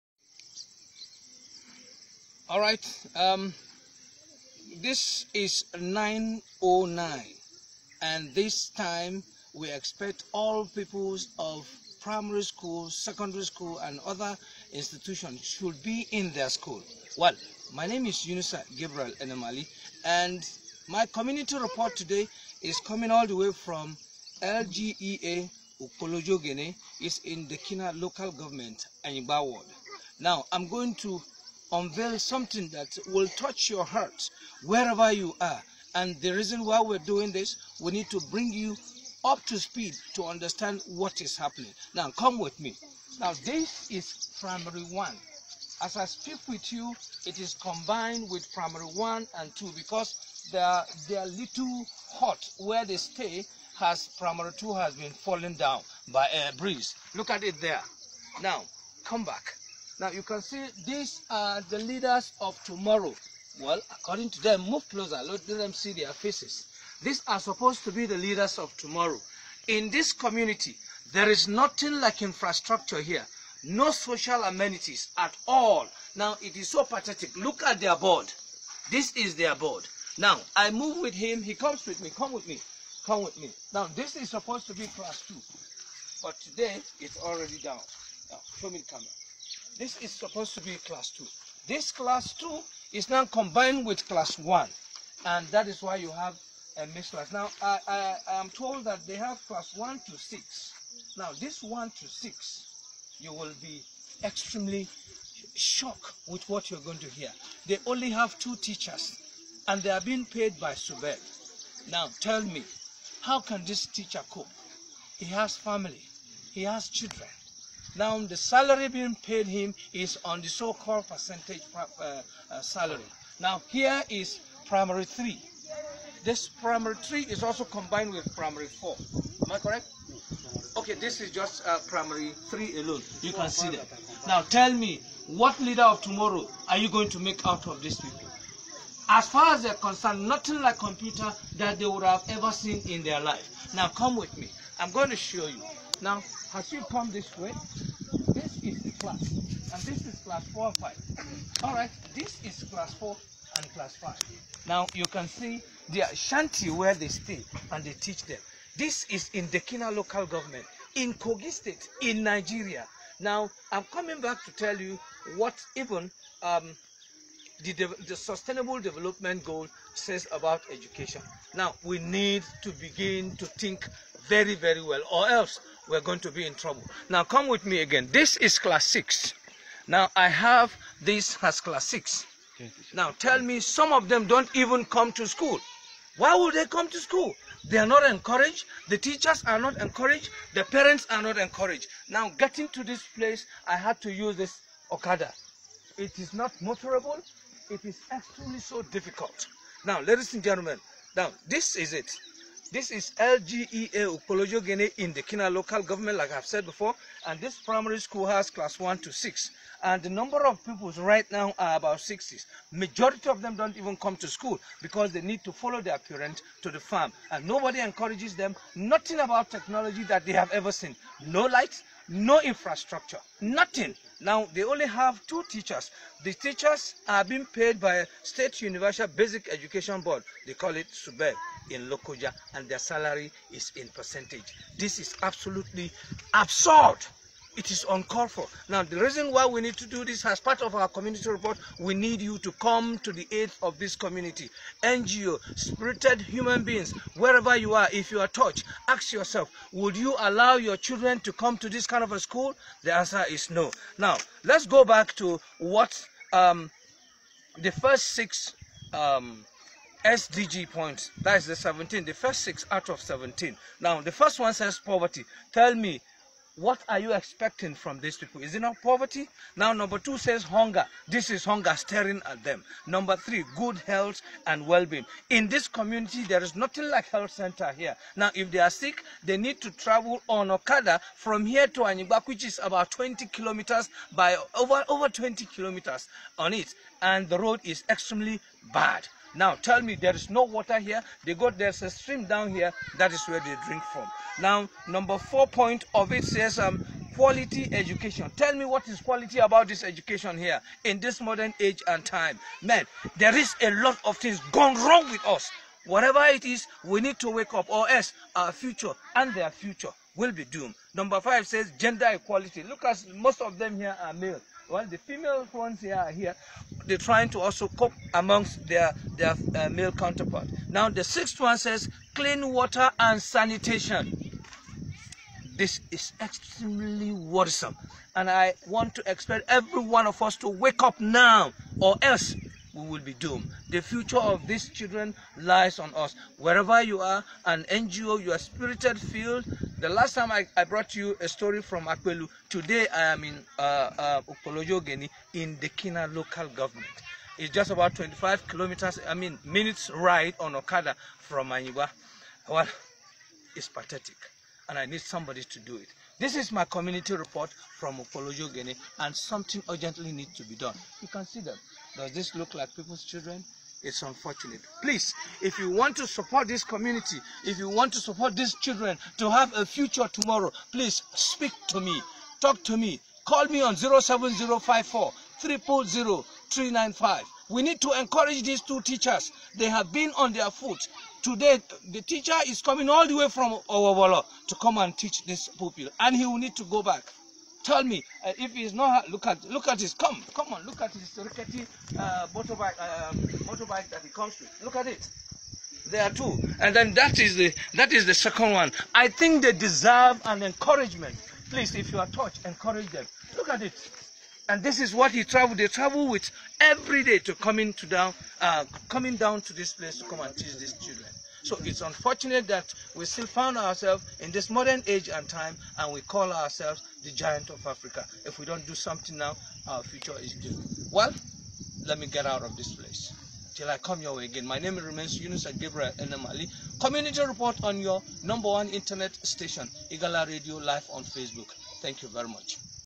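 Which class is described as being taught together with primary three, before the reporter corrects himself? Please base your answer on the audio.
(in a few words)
Primary four.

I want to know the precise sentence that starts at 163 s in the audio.
Now, I'm coming back to tell you what even um, the, the, sustainable development goal says about education.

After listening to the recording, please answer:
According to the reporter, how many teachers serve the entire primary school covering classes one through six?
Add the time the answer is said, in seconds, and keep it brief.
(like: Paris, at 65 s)
2, at 107 s.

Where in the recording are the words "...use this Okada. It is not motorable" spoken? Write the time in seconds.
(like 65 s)
194 s.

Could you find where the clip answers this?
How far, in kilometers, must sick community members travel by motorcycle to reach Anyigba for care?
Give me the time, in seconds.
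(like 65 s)
284 s.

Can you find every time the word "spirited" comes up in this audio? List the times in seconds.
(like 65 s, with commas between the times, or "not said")
245 s, 338 s.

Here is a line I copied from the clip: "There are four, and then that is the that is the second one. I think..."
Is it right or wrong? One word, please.
wrong.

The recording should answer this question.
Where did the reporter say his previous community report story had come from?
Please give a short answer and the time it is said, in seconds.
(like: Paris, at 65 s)
Akwelu, at 341 s.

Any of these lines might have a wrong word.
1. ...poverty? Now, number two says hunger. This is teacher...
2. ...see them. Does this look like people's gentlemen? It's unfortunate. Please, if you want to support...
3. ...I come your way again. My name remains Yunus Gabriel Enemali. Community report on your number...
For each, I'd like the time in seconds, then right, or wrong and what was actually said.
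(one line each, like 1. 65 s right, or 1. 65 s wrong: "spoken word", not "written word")
1. 268 s wrong: "hunger", not "teacher"
2. 361 s wrong: "children", not "gentlemen"
3. 423 s right.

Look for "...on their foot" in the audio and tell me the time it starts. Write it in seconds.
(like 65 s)
380 s.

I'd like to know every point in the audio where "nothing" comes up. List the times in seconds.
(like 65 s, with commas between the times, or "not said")
71 s, 140 s, 218 s, 223 s, 276 s.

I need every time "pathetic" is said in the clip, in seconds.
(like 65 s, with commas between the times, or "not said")
76 s, 353 s.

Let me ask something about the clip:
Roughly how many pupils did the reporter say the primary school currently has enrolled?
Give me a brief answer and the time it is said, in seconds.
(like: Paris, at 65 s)
About 60, at 211 s.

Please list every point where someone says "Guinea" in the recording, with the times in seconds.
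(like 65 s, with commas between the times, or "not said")
358 s.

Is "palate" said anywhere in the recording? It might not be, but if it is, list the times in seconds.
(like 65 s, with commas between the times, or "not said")
not said.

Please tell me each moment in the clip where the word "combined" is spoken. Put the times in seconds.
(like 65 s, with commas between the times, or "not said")
47 s, 93 s, 127 s.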